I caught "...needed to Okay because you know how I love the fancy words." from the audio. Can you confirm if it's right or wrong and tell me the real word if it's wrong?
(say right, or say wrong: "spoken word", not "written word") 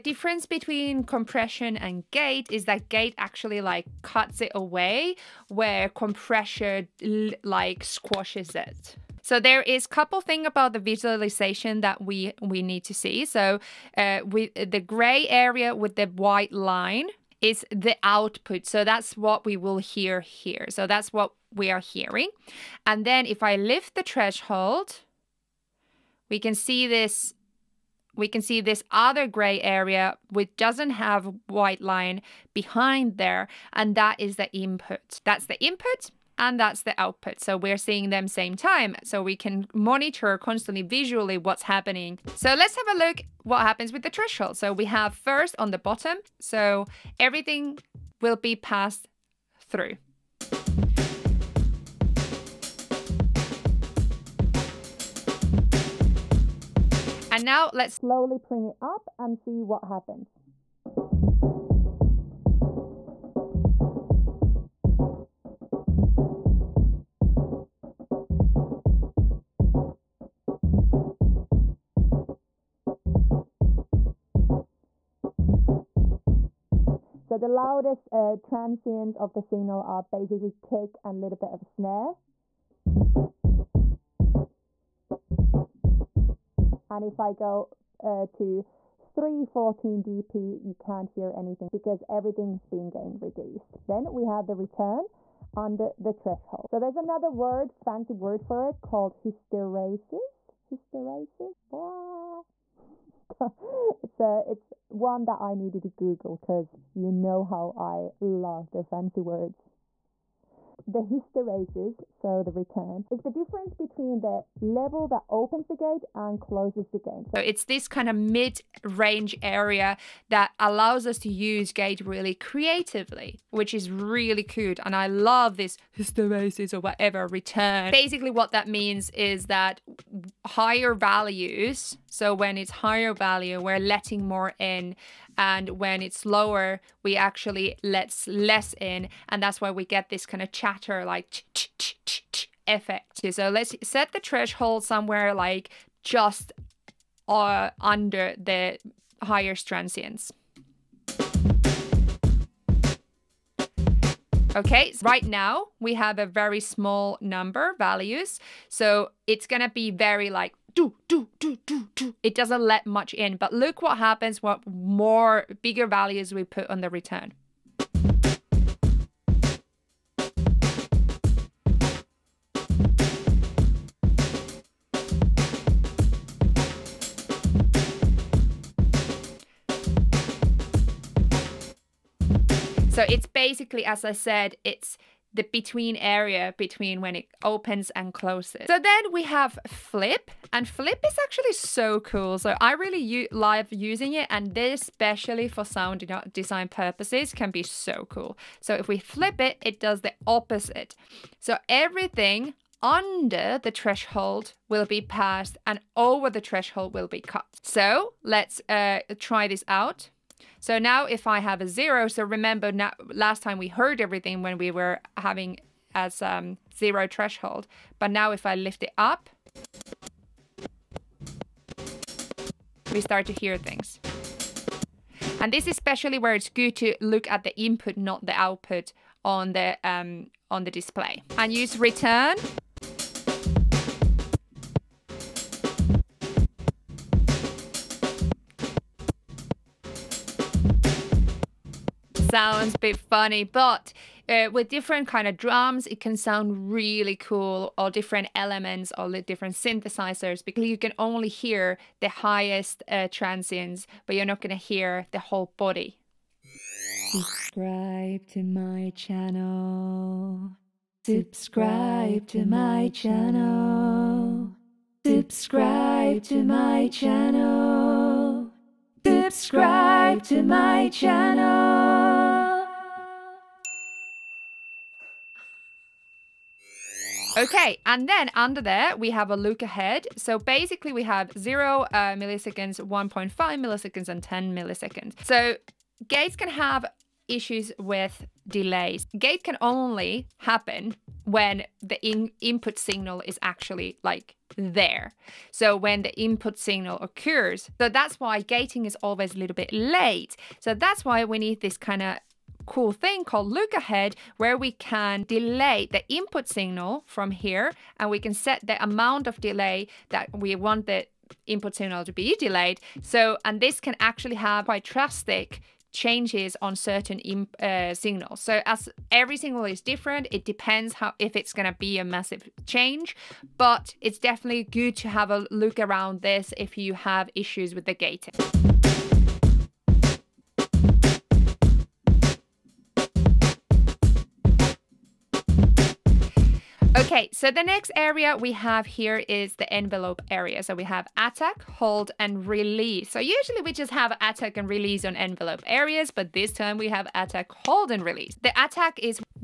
wrong: "Google", not "Okay".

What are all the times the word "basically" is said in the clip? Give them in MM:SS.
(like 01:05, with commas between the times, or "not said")
01:20, 02:07, 03:03, 04:40.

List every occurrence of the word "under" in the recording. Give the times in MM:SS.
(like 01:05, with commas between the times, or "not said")
01:35, 02:27, 03:22, 04:38.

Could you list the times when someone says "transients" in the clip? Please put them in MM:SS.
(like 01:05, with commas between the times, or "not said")
01:18, 02:29, 04:13.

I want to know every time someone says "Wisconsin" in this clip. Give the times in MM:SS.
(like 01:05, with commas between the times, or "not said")
not said.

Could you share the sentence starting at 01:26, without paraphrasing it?
And if I go uh, to 314 dB, you can't hear anything because everything's being gain reduced.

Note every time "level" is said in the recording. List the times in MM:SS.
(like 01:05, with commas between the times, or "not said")
01:54.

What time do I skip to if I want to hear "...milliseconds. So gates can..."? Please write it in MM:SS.
04:44.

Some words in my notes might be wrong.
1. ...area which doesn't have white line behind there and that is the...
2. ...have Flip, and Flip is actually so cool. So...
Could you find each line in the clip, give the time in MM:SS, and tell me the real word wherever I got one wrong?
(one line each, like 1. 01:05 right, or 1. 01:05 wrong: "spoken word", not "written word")
1. 00:29 right
2. 03:09 right.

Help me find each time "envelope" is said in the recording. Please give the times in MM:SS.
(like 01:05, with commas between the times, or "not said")
05:39, 05:45.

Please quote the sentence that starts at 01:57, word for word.
So it's this kind of mid range area that allows us to use gate really creatively, which is really cute.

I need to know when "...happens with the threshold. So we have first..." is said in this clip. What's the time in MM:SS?
00:43.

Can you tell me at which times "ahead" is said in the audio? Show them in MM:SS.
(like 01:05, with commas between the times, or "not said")
04:39, 05:03.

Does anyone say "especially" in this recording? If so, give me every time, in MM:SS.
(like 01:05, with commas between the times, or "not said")
03:14, 03:45.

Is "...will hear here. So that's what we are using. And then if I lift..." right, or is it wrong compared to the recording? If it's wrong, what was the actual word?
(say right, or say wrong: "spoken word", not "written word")
wrong: "hearing", not "using".